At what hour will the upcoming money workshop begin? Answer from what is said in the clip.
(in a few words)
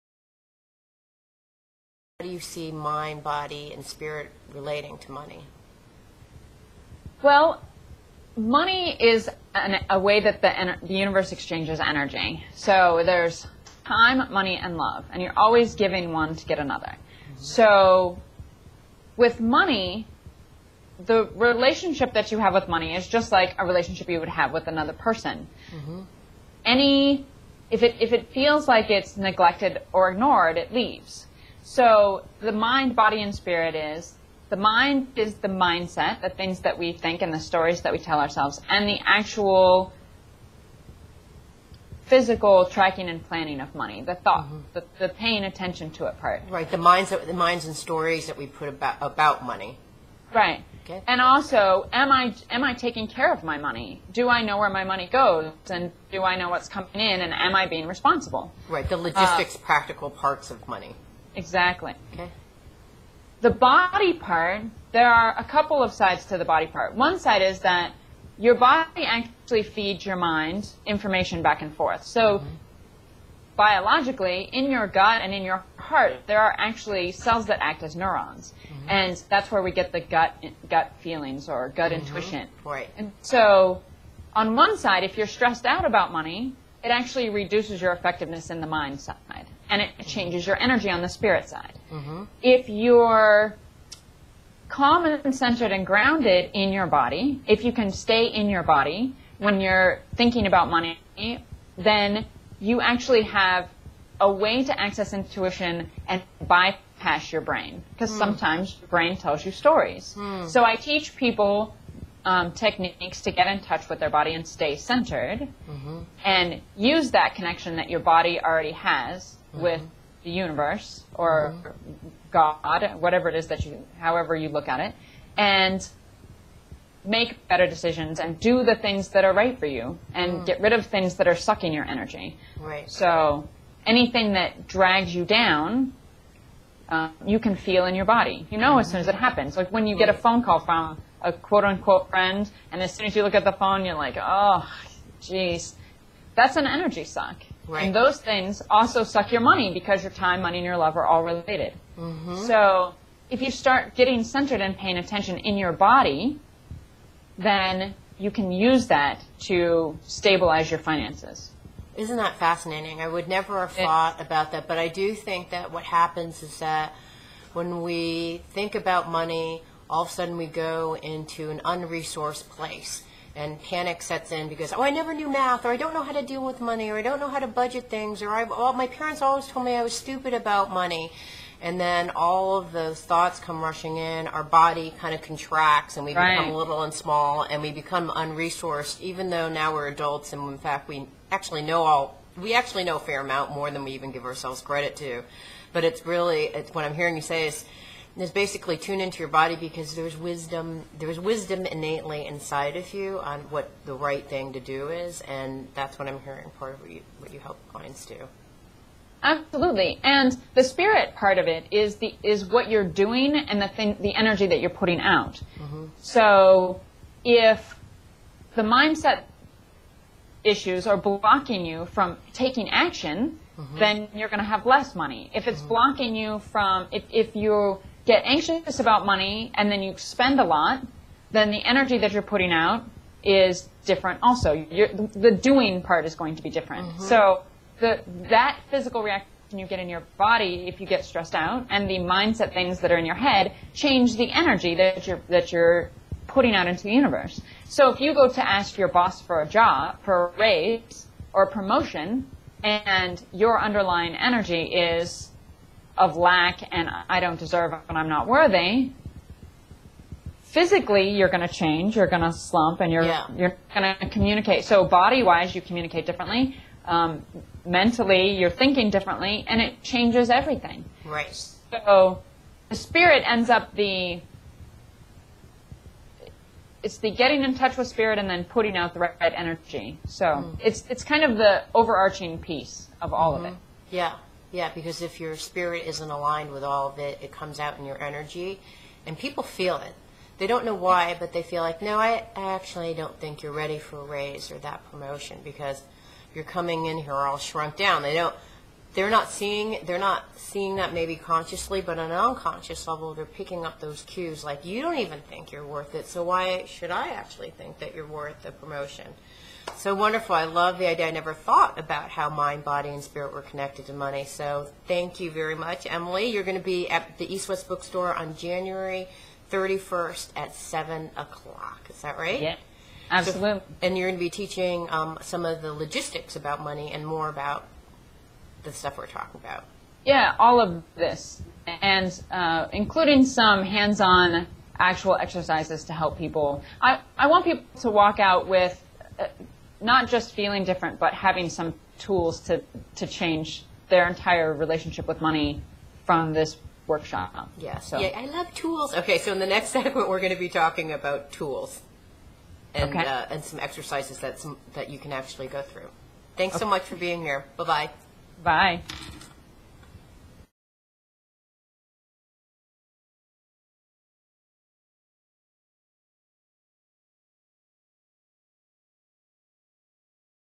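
7 o'clock.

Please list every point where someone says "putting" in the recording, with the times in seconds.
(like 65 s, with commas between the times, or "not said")
214 s, 232 s, 246 s, 278 s.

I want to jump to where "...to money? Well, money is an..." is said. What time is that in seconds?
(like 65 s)
4 s.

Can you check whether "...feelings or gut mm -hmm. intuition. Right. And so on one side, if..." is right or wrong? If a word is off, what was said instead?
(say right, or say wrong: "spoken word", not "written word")
right.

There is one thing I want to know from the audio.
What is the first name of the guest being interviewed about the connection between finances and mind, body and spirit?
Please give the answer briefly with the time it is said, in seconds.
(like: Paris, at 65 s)
Emily, at 315 s.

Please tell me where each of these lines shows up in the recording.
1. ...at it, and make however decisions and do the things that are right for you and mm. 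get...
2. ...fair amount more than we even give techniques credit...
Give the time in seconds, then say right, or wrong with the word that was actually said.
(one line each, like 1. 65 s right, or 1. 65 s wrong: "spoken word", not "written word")
1. 124 s wrong: "better", not "however"
2. 192 s wrong: "ourselves", not "techniques".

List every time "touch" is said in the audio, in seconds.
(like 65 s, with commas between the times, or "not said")
113 s, 277 s.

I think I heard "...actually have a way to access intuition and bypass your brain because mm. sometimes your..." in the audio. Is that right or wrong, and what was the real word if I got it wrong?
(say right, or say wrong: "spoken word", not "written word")
right.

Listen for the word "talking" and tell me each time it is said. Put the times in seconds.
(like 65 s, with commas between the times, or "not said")
329 s, 350 s.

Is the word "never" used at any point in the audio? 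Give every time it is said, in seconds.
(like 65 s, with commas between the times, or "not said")
163 s, 174 s, 311 s.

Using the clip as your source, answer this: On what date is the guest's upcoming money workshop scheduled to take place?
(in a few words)
January 31st.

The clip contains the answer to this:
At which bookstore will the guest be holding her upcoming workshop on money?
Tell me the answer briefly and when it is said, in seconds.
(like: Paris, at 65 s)
East West Bookstore, at 317 s.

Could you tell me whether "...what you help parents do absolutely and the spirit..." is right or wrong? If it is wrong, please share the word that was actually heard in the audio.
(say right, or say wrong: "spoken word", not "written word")
wrong: "clients", not "parents".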